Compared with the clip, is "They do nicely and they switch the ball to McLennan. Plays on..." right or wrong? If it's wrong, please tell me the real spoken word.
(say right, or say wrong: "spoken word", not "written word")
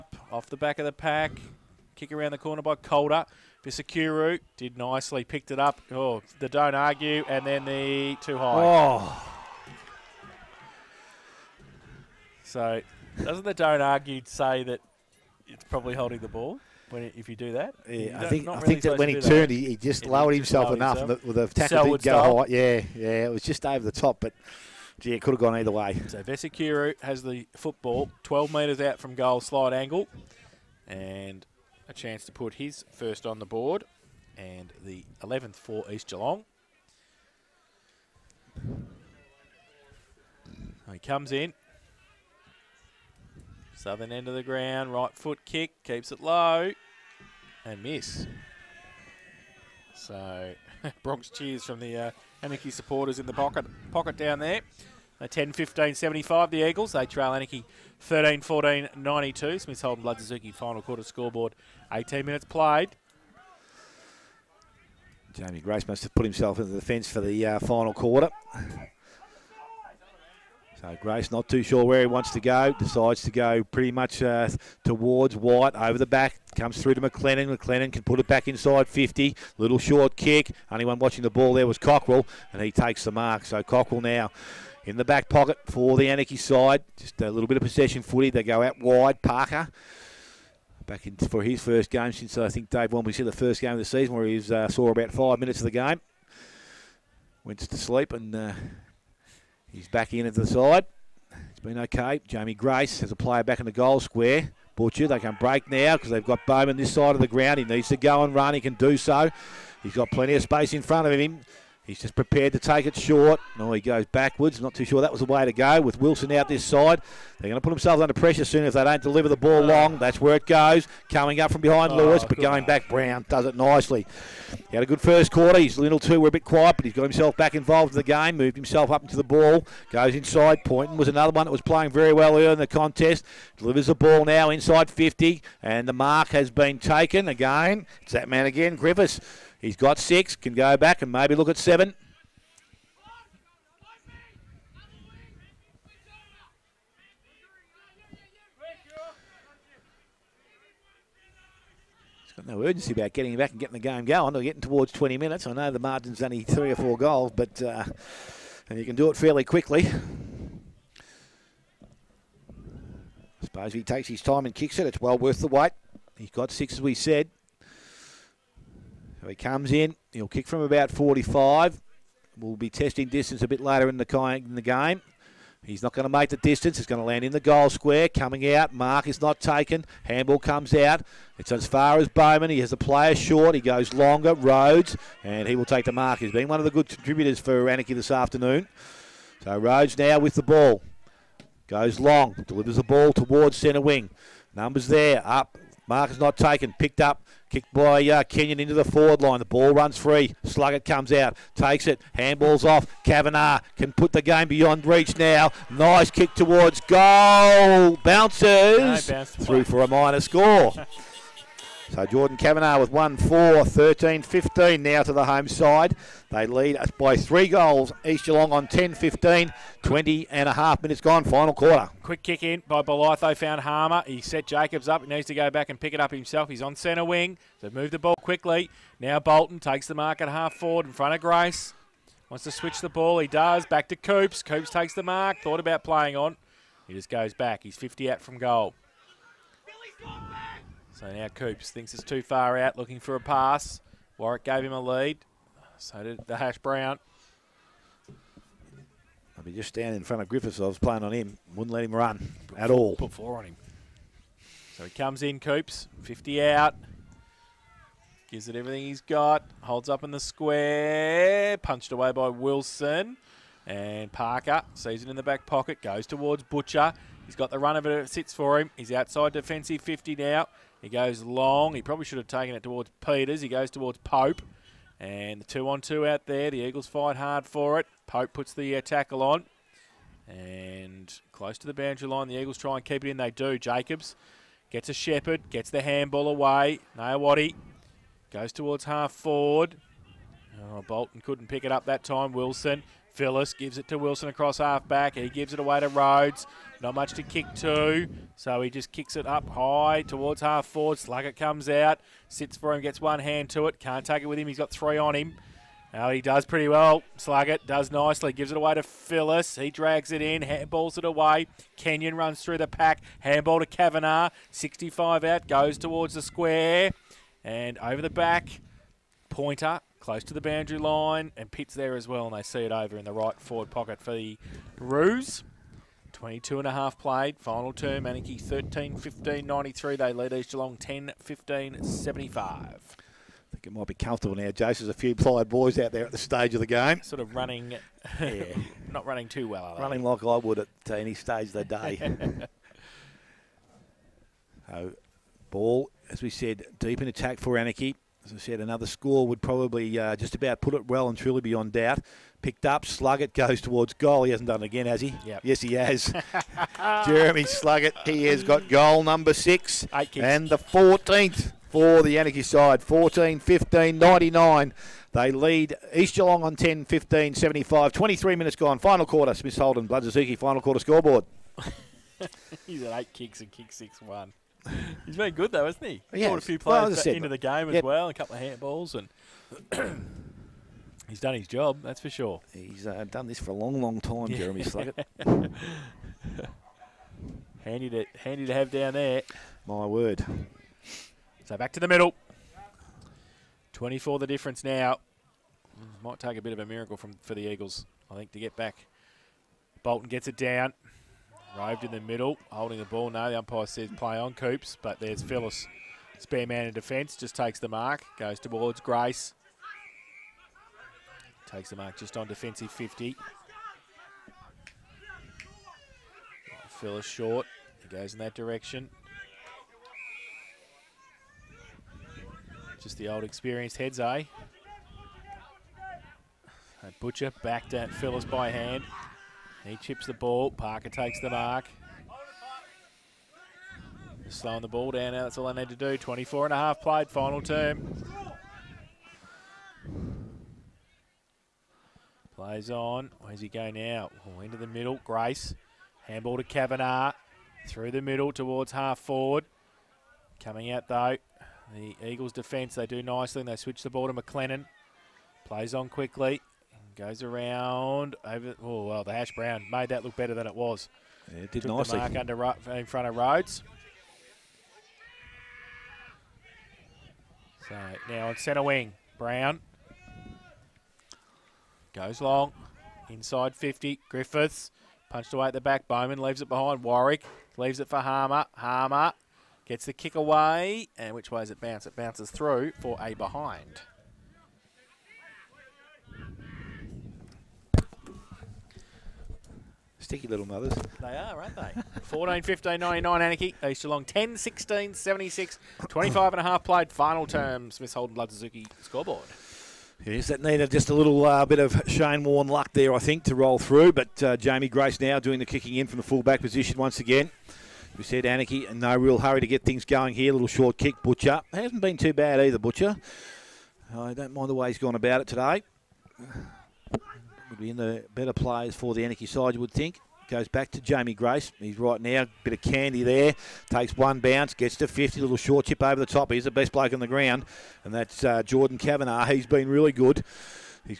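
right.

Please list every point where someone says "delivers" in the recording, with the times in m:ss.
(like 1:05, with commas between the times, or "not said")
1:59, 2:13, 3:12.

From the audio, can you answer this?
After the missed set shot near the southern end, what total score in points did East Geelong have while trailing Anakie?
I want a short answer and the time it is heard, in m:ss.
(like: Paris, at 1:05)
75, at 0:55.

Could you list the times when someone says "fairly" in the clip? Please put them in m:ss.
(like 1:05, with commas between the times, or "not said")
2:39.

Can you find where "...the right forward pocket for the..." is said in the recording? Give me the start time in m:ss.
5:23.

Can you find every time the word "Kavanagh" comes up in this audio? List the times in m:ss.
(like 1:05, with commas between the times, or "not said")
3:23, 3:32, 5:13, 7:26, 8:48.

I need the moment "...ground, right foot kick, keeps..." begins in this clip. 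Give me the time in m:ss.
0:44.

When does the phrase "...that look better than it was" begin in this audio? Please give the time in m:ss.
7:39.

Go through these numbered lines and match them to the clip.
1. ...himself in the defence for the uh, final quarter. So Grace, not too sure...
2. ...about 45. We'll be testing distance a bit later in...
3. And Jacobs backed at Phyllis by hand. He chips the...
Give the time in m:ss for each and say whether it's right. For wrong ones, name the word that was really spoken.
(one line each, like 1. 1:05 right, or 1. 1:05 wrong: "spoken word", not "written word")
1. 1:06 right
2. 2:50 right
3. 7:06 wrong: "Butcher", not "Jacobs".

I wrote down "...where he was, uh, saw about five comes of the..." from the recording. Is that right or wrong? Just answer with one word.
wrong.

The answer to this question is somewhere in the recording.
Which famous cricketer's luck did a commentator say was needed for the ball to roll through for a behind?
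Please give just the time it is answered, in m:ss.
8:21.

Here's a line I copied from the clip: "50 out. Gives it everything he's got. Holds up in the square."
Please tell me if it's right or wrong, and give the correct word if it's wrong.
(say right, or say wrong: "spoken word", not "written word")
right.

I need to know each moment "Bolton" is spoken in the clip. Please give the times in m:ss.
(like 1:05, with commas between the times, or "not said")
3:49, 4:50, 6:39.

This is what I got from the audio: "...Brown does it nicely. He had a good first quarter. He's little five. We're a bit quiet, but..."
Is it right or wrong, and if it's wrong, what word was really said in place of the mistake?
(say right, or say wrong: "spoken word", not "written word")
wrong: "two", not "five".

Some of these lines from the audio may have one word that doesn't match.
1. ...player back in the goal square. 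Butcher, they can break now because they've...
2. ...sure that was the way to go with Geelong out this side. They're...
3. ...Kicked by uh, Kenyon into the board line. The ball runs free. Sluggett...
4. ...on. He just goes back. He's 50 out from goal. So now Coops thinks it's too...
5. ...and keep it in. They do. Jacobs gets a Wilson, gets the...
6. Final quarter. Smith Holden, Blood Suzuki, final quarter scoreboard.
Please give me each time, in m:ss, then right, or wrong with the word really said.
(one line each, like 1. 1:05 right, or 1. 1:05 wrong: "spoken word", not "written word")
1. 1:43 right
2. 1:54 wrong: "Wilson", not "Geelong"
3. 3:17 wrong: "forward", not "board"
4. 3:56 right
5. 4:42 wrong: "Shepherd", not "Wilson"
6. 6:08 right.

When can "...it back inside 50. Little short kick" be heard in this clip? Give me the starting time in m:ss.
1:18.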